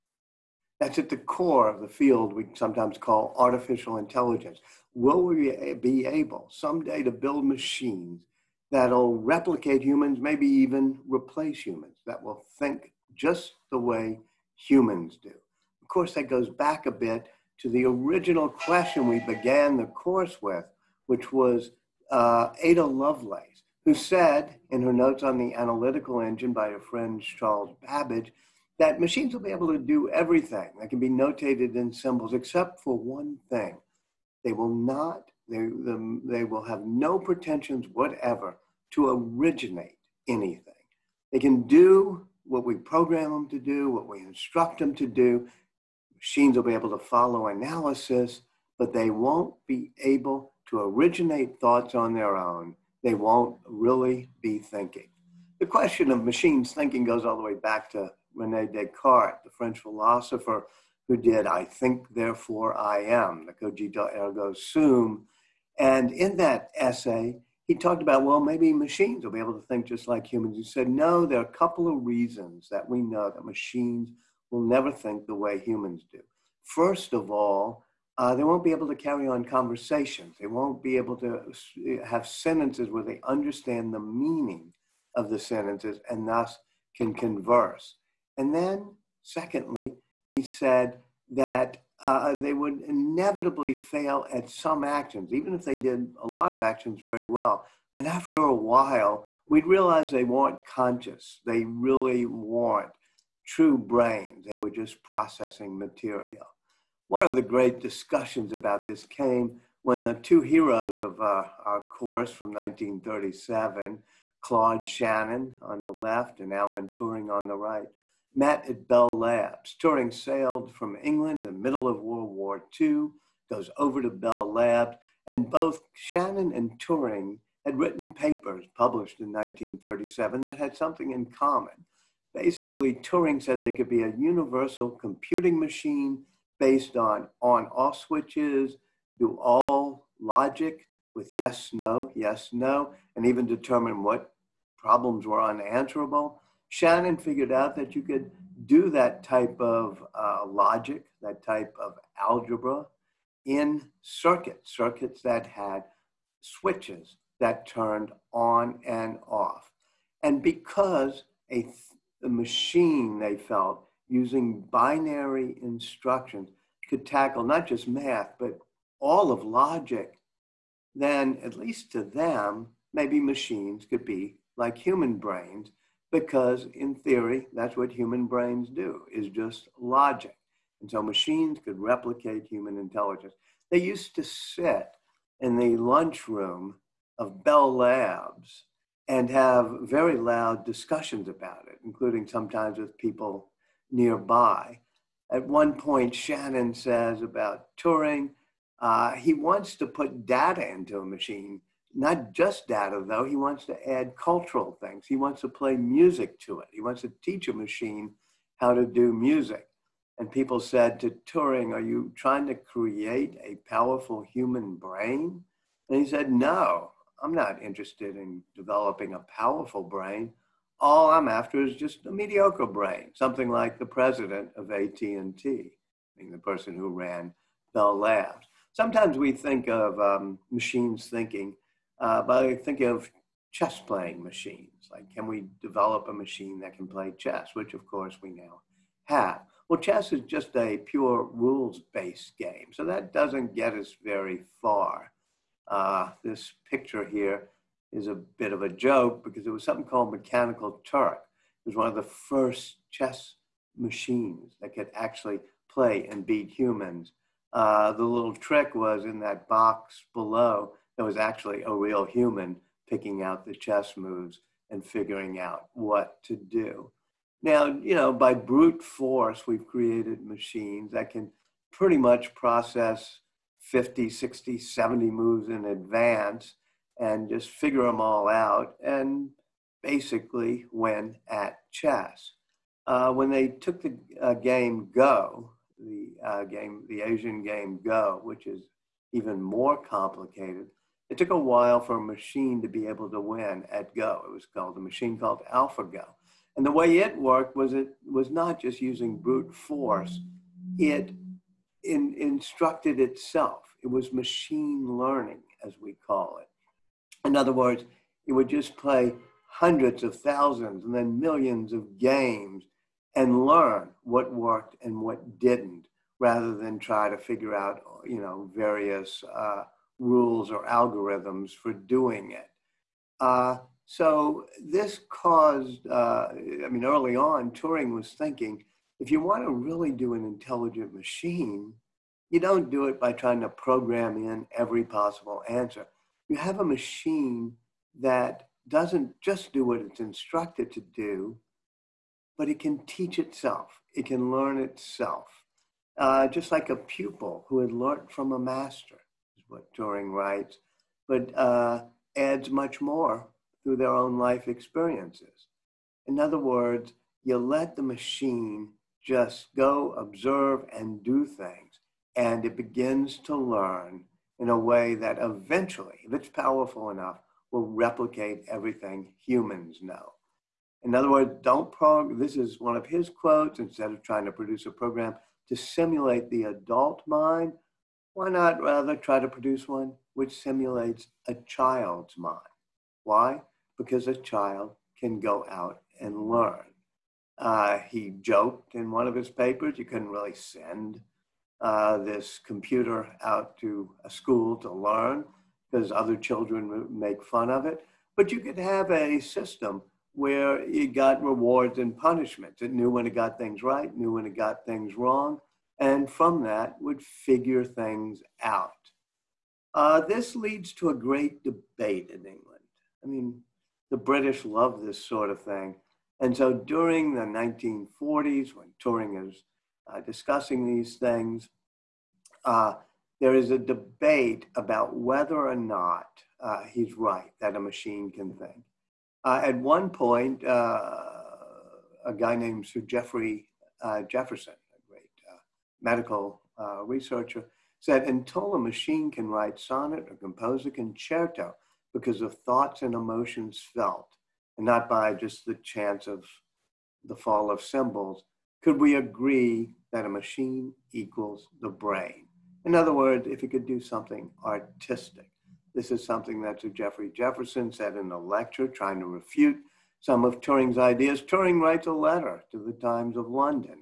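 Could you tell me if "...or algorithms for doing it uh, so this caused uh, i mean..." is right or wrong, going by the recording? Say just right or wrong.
right.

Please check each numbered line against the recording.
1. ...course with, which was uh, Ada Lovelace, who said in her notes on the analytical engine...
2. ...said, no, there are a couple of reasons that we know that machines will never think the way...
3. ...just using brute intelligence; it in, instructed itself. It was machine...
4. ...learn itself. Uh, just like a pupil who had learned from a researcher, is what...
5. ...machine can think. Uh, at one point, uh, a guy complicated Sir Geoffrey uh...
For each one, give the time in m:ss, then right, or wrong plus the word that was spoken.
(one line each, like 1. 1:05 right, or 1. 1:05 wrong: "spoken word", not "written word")
1. 0:19 right
2. 1:10 right
3. 4:58 wrong: "force", not "intelligence"
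4. 5:44 wrong: "master", not "researcher"
5. 7:07 wrong: "named", not "complicated".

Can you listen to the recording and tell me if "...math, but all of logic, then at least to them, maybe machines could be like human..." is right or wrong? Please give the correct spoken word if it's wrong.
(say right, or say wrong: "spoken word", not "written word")
right.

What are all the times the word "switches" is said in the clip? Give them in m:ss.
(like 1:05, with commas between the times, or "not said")
2:17, 2:36.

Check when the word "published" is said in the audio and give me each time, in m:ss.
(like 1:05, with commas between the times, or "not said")
2:08.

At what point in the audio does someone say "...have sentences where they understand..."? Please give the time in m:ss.
1:22.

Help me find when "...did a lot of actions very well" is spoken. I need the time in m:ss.
1:35.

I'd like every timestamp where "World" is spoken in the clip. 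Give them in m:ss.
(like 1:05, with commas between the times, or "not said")
2:02.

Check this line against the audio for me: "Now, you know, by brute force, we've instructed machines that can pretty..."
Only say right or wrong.
wrong.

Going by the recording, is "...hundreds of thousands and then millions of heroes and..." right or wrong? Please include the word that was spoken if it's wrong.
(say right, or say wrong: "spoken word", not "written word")
wrong: "games", not "heroes".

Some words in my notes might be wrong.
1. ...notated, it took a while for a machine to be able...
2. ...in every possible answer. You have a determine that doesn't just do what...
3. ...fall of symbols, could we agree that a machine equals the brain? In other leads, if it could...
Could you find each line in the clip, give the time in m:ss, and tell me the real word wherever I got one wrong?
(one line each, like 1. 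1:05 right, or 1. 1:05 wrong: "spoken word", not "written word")
1. 4:49 wrong: "complicated", not "notated"
2. 5:34 wrong: "machine", not "determine"
3. 7:27 wrong: "words", not "leads".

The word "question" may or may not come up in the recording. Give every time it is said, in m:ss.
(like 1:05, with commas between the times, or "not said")
0:18, 0:55.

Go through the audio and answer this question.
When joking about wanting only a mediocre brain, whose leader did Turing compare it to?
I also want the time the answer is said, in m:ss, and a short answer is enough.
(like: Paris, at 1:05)
president of AT&T, at 3:43.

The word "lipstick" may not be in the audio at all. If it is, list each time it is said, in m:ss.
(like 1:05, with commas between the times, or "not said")
not said.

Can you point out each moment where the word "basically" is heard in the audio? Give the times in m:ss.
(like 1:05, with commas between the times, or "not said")
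2:12, 4:39.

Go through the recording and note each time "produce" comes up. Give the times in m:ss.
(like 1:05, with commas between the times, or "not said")
6:14, 6:19.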